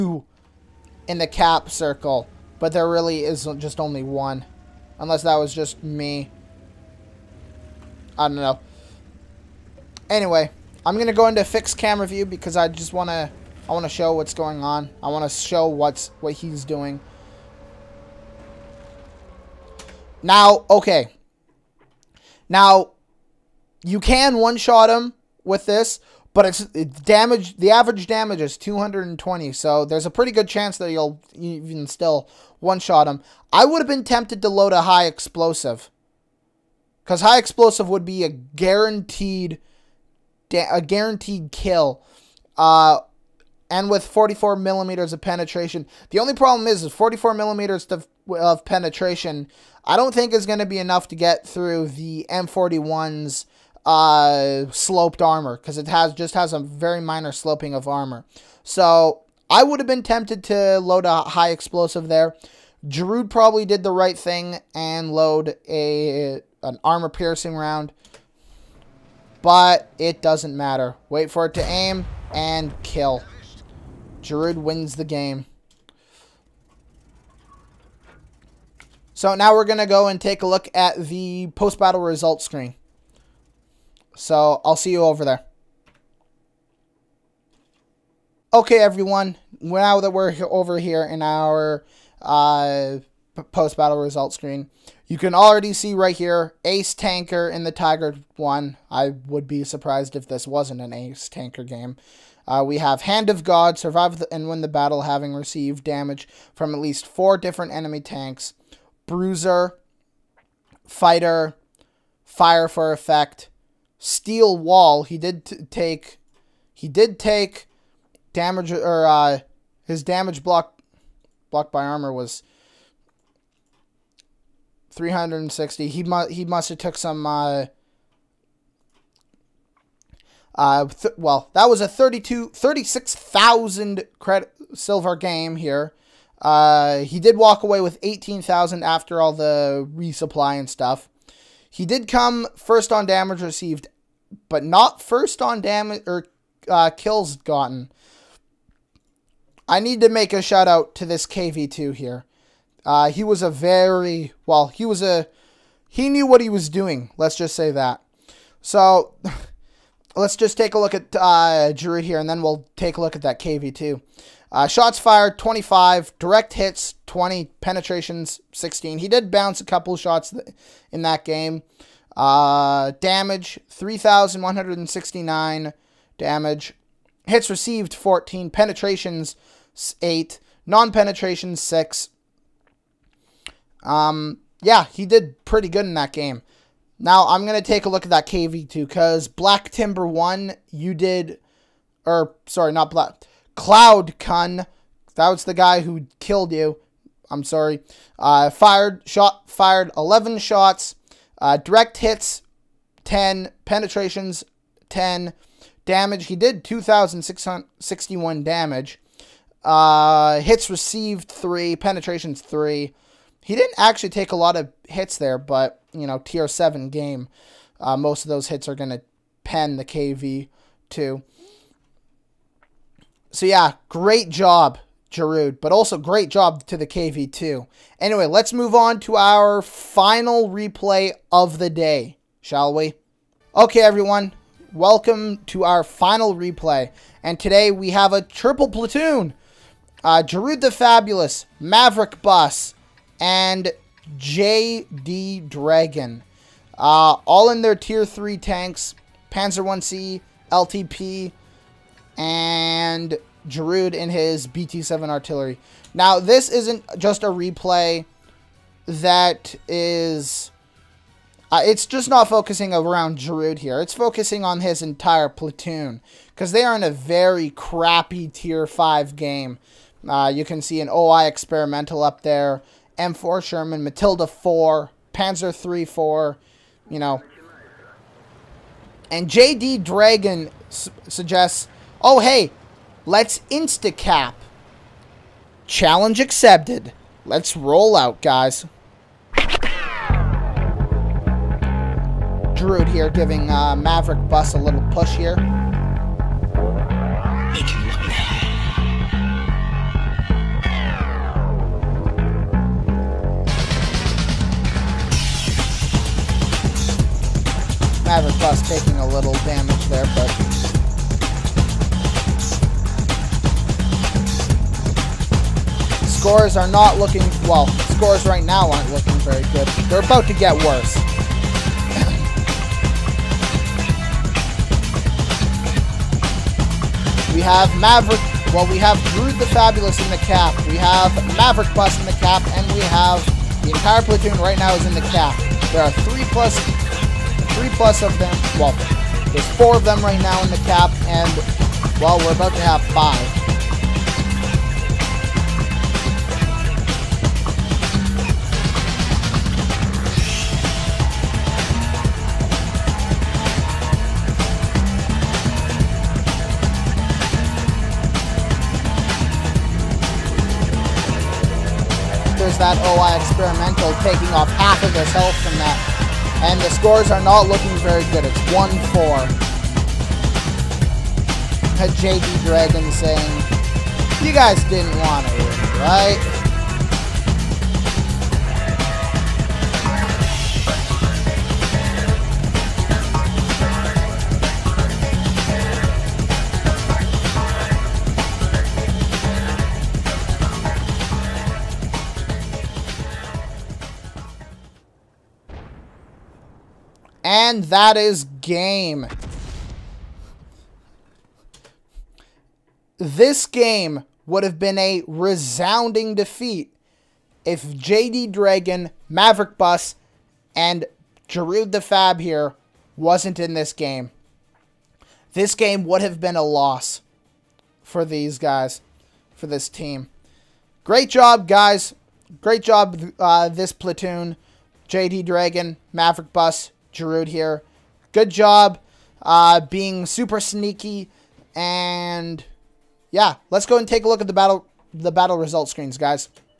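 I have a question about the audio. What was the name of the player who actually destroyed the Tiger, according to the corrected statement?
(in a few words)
Cloud Cun.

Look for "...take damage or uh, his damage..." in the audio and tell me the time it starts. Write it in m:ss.
1:57.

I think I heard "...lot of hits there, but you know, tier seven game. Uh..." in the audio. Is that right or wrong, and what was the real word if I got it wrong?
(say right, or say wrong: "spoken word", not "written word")
right.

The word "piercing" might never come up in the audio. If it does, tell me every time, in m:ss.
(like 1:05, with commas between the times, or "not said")
1:07.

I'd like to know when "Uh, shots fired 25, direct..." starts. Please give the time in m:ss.
2:44.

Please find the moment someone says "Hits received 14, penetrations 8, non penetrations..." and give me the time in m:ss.
2:57.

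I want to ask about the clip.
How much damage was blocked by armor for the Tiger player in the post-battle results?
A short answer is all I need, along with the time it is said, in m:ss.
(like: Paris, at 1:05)
360, at 2:04.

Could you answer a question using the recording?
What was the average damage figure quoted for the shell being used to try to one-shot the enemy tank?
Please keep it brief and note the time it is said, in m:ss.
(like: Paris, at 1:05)
220, at 0:28.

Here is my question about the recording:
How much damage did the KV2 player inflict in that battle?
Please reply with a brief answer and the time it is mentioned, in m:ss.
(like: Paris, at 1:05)
2,661, at 3:26.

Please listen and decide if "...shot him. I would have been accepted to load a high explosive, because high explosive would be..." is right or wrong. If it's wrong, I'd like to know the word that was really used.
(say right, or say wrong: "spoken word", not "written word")
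wrong: "tempted", not "accepted".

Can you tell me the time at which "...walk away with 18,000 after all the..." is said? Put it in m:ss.
2:17.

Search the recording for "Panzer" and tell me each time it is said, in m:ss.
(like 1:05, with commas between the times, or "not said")
4:09, 4:35.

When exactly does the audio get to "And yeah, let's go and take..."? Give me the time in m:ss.
7:11.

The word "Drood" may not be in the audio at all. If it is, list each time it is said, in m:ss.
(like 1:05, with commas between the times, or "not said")
1:02, 1:14.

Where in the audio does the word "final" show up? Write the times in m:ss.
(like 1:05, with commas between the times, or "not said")
3:49, 3:55.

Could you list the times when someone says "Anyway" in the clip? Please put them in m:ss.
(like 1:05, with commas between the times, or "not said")
0:10, 3:47.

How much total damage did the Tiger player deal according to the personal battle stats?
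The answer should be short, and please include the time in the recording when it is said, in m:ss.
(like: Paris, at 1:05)
3,169, at 2:53.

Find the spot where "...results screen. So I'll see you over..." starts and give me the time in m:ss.
1:22.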